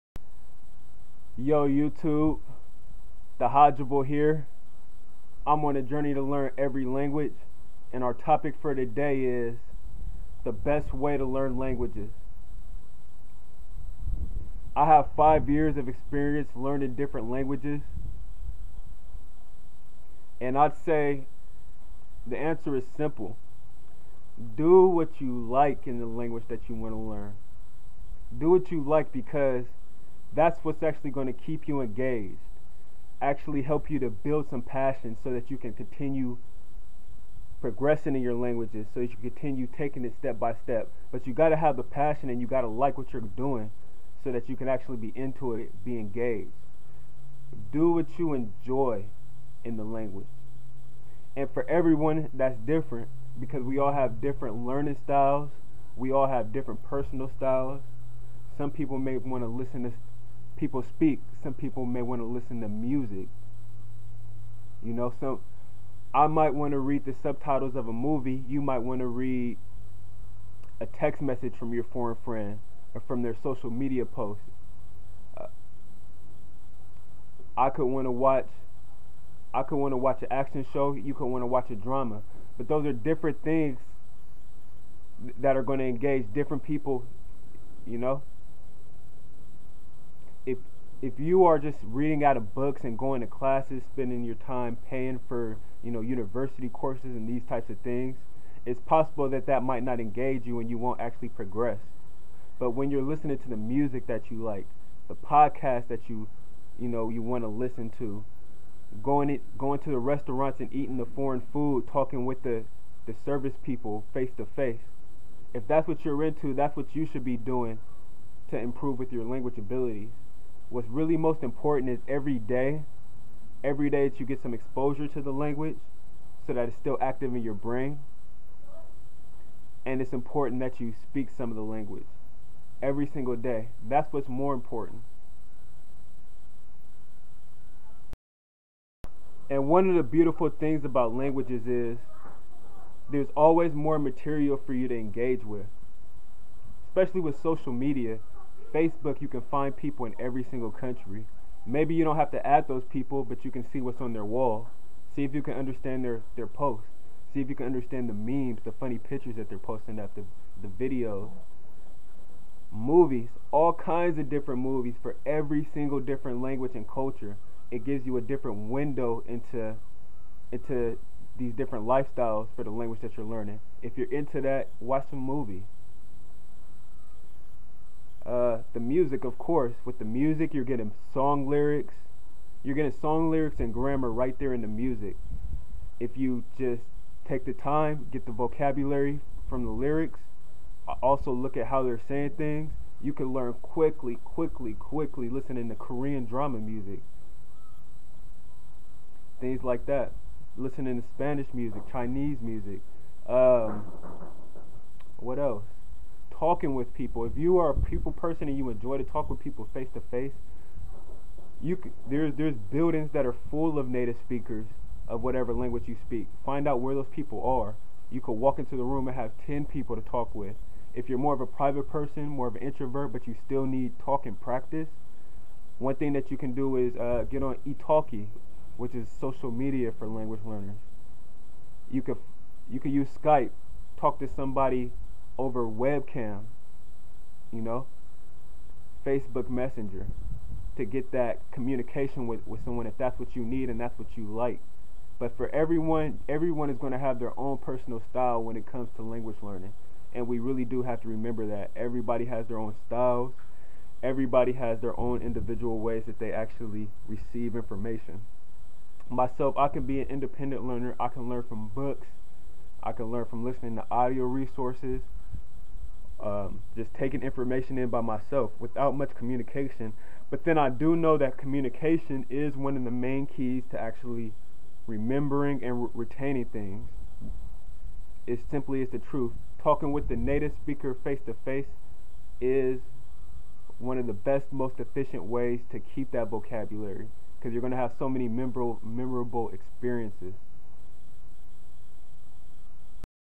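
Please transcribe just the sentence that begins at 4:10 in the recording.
And we really do have to remember that.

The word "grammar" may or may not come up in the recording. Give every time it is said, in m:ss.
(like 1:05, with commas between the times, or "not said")
3:03.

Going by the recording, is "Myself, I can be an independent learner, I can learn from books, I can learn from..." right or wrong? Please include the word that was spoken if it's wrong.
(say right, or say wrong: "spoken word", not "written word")
right.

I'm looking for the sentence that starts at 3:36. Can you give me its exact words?
Find out where those people are.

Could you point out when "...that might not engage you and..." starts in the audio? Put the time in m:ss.
1:39.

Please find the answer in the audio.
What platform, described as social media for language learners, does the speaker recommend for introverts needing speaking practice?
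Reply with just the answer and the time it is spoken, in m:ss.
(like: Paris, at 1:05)
italki, at 3:47.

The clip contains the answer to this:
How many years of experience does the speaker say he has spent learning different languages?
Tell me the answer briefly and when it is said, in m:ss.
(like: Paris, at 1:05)
5, at 0:15.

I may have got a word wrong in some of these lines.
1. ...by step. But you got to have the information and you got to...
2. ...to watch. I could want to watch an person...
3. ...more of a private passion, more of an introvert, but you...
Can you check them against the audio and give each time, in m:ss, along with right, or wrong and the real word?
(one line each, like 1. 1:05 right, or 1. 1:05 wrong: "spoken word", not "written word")
1. 0:40 wrong: "passion", not "information"
2. 1:18 wrong: "action", not "person"
3. 3:41 wrong: "person", not "passion".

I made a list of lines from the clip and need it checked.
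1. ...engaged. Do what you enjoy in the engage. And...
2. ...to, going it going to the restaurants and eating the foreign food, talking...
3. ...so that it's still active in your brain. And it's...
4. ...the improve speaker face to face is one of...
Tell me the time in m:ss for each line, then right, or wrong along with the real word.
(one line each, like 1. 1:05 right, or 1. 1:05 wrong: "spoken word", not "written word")
1. 0:45 wrong: "language", not "engage"
2. 1:47 right
3. 2:06 right
4. 4:40 wrong: "native", not "improve".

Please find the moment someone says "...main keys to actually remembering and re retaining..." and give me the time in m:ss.
4:32.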